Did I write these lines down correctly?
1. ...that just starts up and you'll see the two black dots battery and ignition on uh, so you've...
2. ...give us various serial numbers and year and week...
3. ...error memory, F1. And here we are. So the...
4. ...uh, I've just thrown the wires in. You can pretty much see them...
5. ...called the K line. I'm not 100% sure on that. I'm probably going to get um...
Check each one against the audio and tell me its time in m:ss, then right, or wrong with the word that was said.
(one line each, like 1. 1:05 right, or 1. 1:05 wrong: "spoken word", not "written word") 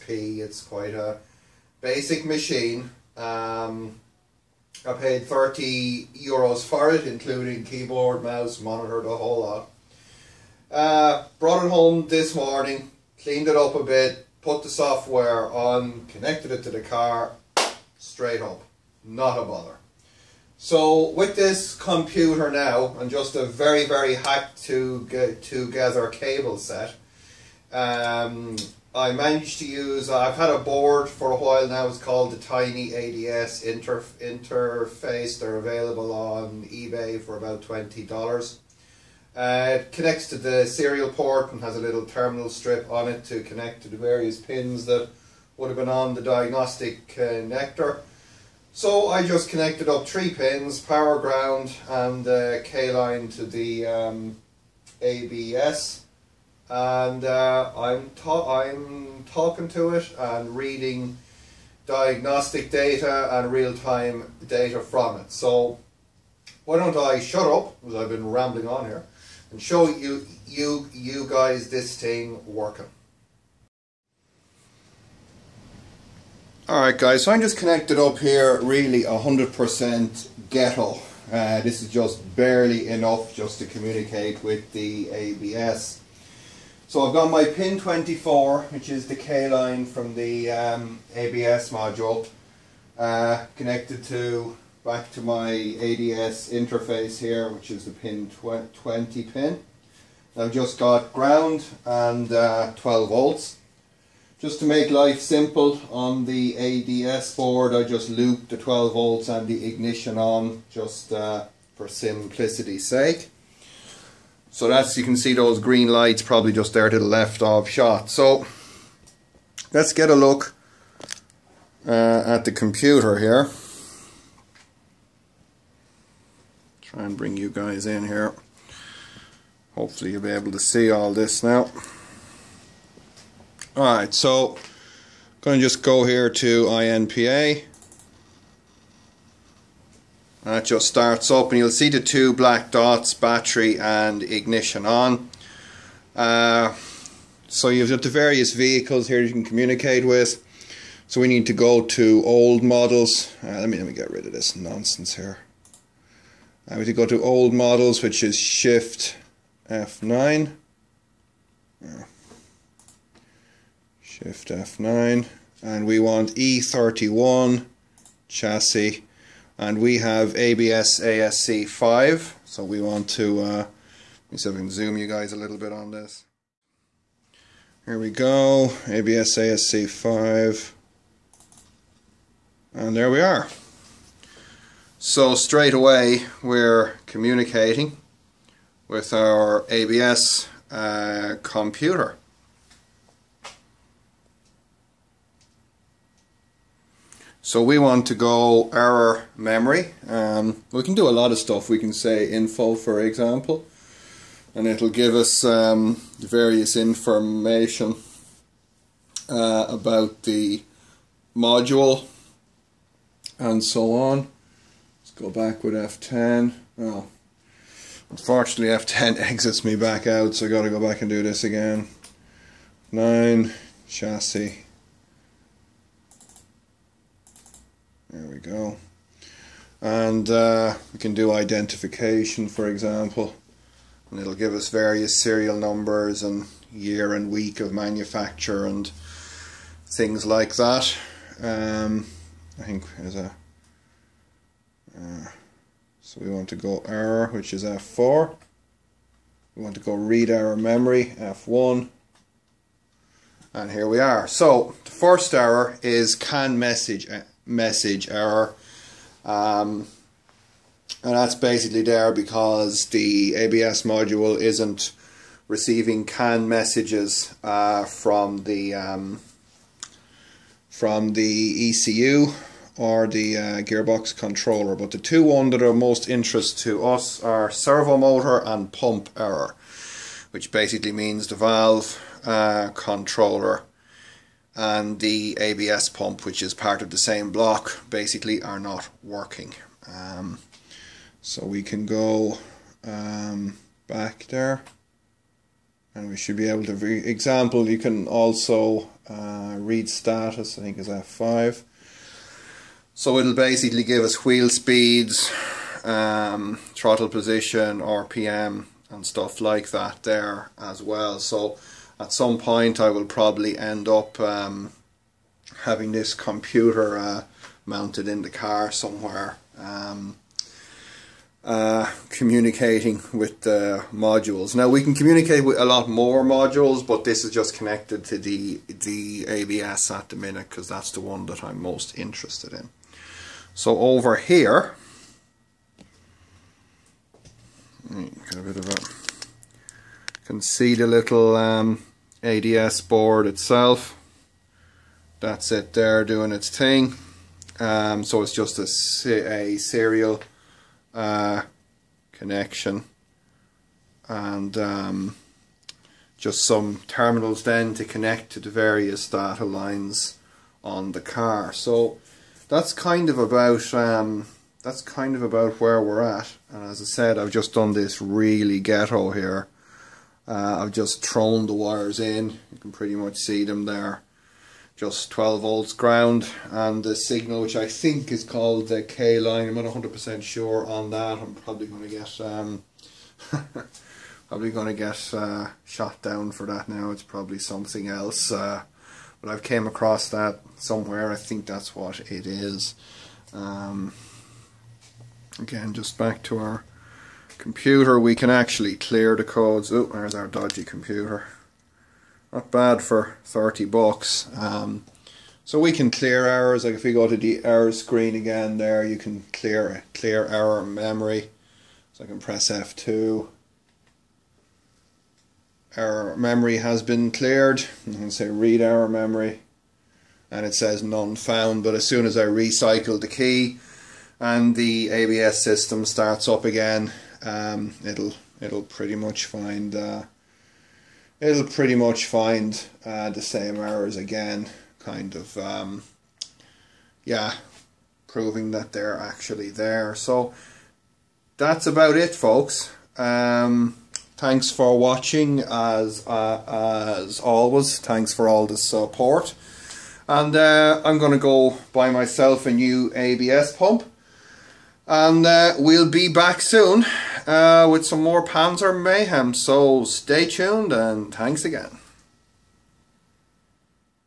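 1. 2:20 right
2. 3:54 right
3. 4:10 right
4. 6:10 right
5. 6:18 right.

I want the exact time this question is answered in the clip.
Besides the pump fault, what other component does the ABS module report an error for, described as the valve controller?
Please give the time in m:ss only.
4:37.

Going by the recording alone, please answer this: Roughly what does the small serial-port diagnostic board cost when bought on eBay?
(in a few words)
$20.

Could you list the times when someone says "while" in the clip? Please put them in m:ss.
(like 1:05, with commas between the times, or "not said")
0:31.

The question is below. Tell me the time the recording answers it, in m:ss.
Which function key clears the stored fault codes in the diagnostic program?
6:52.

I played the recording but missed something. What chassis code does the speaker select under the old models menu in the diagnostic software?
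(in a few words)
E31.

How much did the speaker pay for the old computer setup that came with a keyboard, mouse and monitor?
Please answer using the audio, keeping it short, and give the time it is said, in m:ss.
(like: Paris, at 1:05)
30 euros, at 0:05.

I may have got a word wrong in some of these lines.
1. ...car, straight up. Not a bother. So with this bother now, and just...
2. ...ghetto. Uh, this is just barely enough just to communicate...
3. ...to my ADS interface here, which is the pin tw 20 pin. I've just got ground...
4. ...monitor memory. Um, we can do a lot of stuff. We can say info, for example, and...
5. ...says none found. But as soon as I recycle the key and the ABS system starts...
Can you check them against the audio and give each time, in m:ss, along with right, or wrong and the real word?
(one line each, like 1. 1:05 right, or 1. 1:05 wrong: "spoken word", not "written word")
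1. 0:16 wrong: "computer", not "bother"
2. 1:20 right
3. 1:35 right
4. 3:18 wrong: "error", not "monitor"
5. 7:00 right.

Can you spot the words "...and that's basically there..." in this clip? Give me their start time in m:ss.
4:21.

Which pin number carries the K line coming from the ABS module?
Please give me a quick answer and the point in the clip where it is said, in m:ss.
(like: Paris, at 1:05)
24, at 1:27.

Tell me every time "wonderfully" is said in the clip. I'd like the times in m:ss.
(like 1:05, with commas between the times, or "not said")
not said.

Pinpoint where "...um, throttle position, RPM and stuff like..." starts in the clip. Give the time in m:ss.
5:05.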